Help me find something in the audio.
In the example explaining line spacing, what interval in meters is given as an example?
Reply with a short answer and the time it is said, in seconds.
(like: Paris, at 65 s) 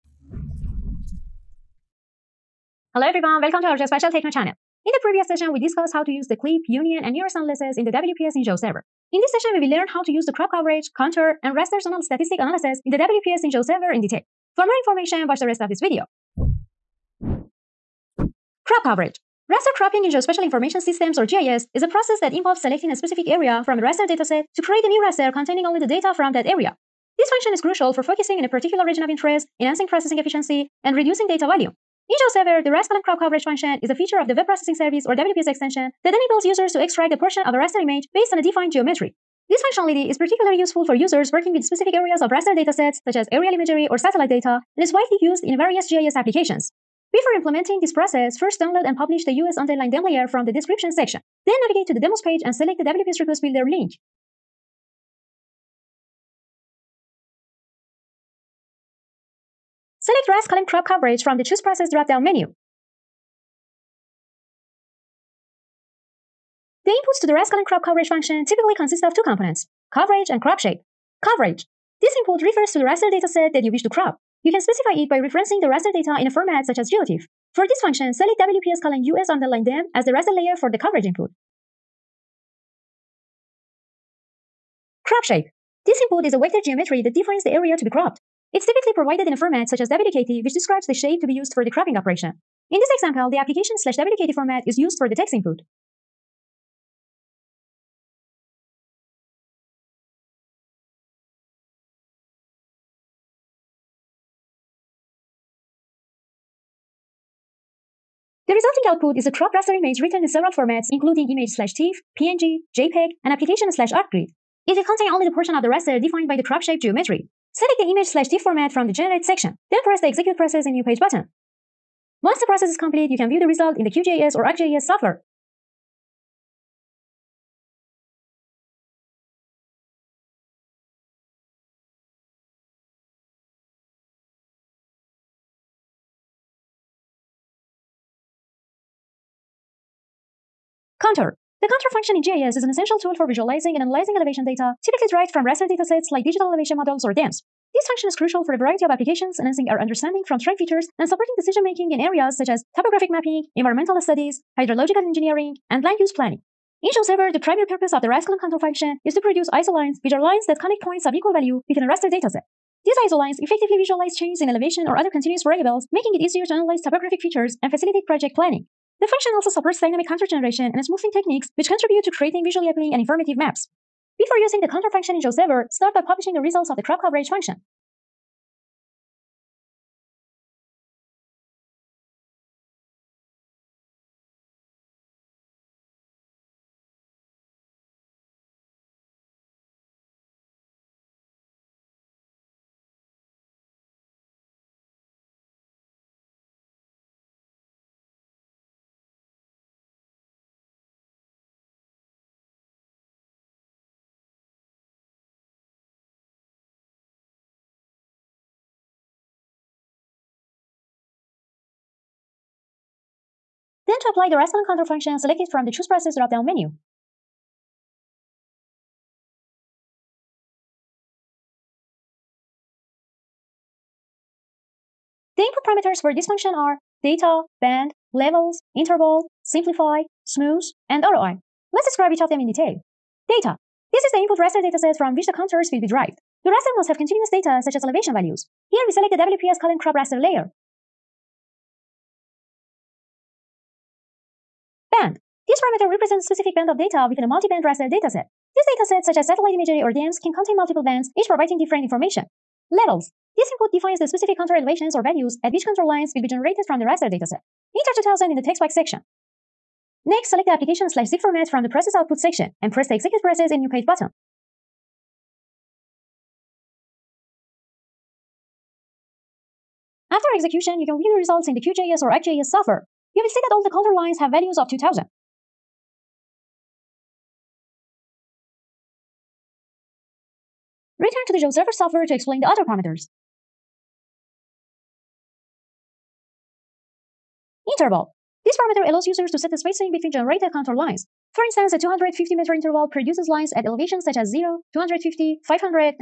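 250 meters, at 291 s.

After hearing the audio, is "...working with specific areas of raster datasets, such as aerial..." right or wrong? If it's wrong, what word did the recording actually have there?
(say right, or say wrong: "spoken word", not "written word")
right.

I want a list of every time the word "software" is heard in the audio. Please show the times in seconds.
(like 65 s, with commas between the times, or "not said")
124 s, 272 s, 281 s.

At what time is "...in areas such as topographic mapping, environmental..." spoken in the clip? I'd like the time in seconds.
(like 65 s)
151 s.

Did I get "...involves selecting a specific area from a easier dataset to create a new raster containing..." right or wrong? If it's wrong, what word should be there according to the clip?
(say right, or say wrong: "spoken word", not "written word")
wrong: "raster", not "easier".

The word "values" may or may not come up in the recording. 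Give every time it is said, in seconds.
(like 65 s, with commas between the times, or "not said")
161 s, 238 s, 255 s, 274 s.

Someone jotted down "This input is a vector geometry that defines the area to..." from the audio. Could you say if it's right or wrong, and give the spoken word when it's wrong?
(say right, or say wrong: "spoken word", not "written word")
right.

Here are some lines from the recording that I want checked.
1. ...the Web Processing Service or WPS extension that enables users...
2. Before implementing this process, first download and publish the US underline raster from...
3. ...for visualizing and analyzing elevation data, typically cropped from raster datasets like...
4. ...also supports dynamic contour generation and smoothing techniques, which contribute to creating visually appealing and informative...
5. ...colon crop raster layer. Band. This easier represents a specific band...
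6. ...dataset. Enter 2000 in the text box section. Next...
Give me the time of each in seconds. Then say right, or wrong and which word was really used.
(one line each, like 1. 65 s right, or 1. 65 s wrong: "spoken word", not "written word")
1. 34 s right
2. 47 s wrong: "layer", not "raster"
3. 143 s wrong: "derived", not "cropped"
4. 169 s right
5. 239 s wrong: "parameter", not "easier"
6. 257 s right.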